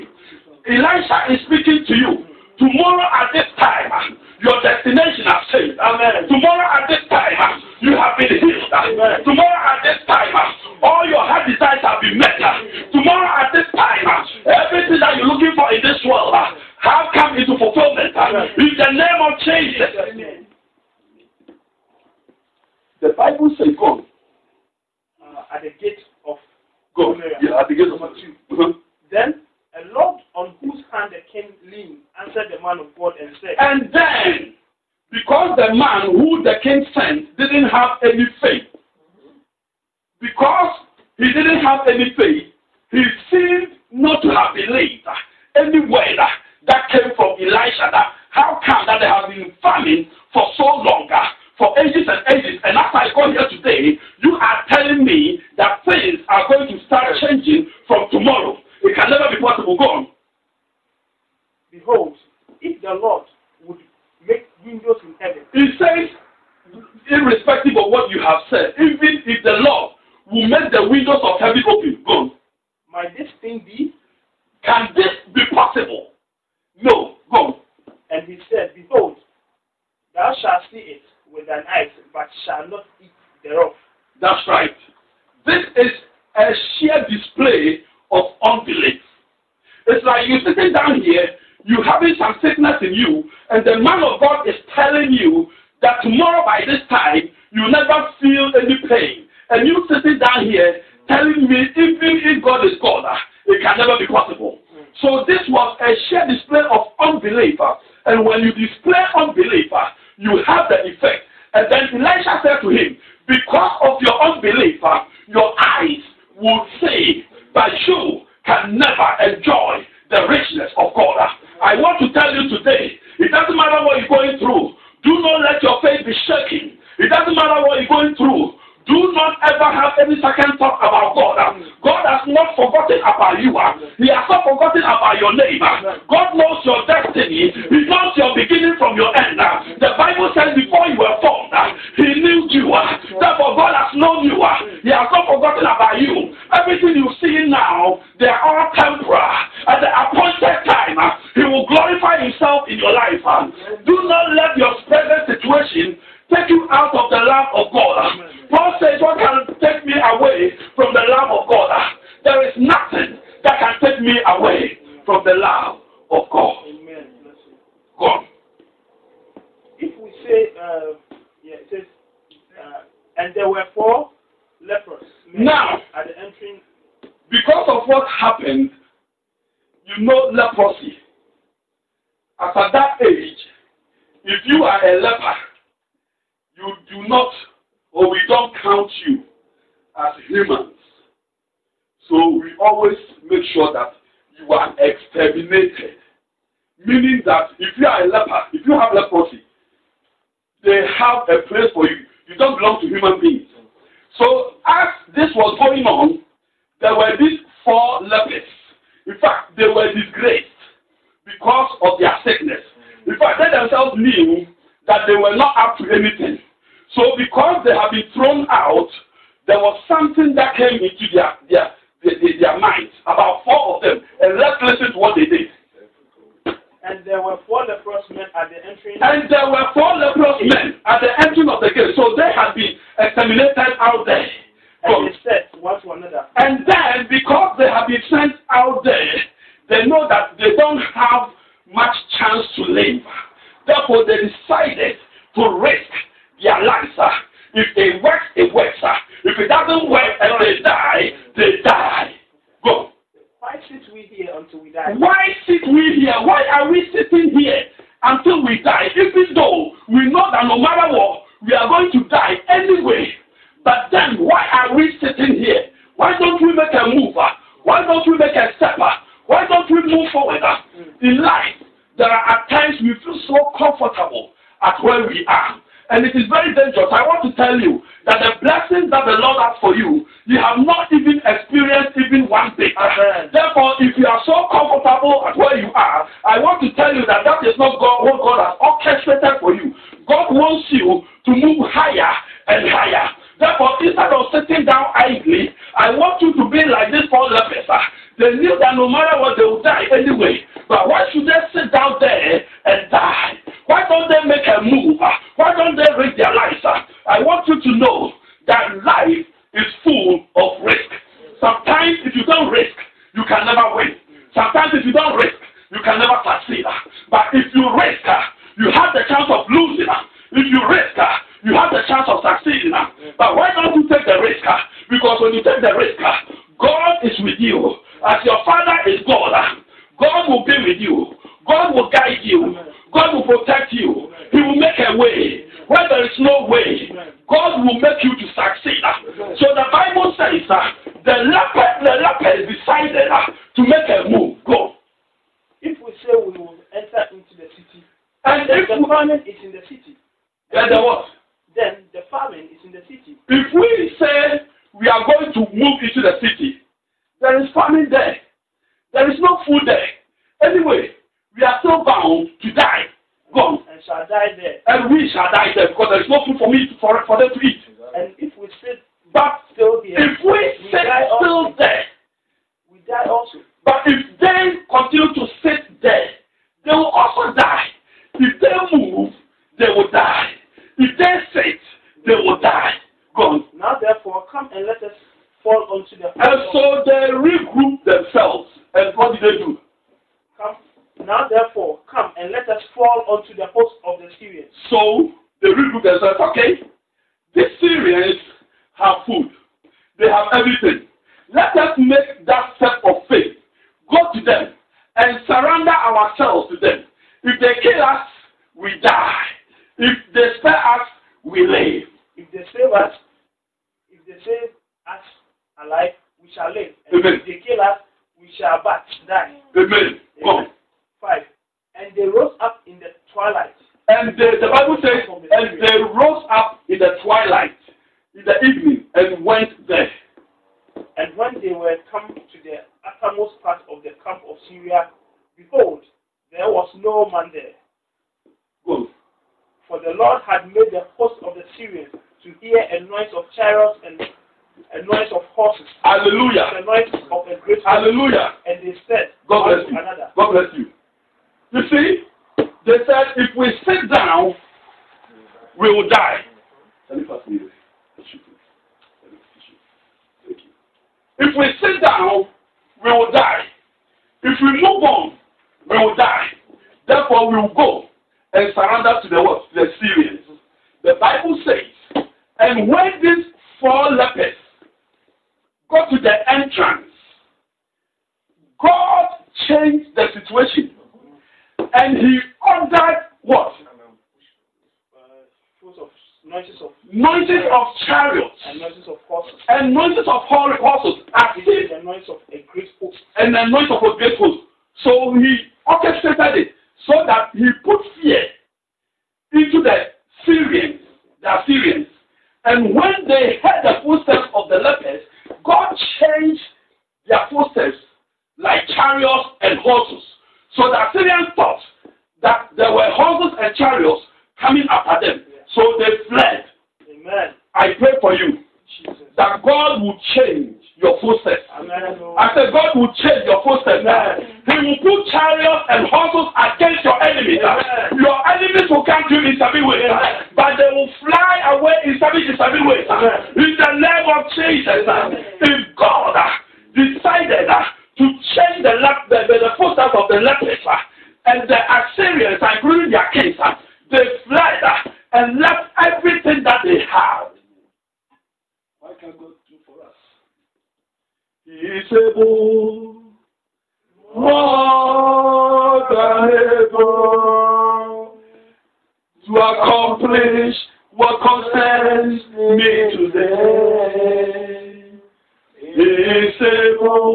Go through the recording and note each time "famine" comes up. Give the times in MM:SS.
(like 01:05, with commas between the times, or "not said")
00:49, 05:48.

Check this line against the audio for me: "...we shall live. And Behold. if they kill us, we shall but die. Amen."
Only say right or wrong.
wrong.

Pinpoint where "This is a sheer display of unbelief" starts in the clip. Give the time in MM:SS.
01:25.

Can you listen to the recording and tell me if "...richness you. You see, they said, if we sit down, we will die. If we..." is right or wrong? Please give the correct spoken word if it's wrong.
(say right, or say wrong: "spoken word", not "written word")
wrong: "bless", not "richness".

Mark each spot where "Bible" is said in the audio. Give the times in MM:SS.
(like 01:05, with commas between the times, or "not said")
00:23, 05:39, 07:04, 07:50.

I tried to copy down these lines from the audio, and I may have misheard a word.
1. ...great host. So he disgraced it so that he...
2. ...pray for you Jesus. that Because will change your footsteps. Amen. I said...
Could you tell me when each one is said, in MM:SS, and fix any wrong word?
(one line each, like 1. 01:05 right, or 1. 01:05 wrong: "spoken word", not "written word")
1. 08:13 wrong: "orchestrated", not "disgraced"
2. 08:37 wrong: "God", not "Because".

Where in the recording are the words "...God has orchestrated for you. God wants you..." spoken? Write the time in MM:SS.
04:48.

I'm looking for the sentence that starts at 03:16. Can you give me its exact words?
Meaning that if you are a leper, if you have leprosy, they have a place for you.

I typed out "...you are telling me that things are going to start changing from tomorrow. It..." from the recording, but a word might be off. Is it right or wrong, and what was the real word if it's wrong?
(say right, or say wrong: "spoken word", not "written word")
right.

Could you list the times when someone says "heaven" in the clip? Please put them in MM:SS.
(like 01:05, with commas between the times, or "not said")
01:05, 01:11.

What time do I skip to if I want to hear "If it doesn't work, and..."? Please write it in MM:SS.
04:09.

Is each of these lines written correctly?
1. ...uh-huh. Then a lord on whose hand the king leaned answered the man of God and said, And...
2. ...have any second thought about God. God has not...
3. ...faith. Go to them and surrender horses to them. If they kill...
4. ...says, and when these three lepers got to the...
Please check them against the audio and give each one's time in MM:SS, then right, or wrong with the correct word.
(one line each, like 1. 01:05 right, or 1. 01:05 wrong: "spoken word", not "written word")
1. 00:28 right
2. 02:09 right
3. 06:43 wrong: "ourselves", not "horses"
4. 07:51 wrong: "four", not "three".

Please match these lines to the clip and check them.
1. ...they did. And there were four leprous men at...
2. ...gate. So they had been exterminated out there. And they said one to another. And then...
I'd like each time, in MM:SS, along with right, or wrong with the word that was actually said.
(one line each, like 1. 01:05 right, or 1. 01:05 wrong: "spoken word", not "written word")
1. 03:45 right
2. 03:51 right.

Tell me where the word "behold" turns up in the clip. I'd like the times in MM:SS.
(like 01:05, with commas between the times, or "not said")
01:01, 01:18, 07:15.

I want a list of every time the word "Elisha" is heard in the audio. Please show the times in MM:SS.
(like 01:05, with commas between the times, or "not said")
00:00, 00:47, 01:52.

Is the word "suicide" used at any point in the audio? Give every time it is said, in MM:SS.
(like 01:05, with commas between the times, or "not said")
not said.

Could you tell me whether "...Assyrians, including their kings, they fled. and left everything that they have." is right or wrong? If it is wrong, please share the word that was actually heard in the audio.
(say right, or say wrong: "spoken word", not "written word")
right.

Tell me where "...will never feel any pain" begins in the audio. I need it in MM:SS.
01:37.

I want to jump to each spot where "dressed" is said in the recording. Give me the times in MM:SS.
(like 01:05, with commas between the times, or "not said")
not said.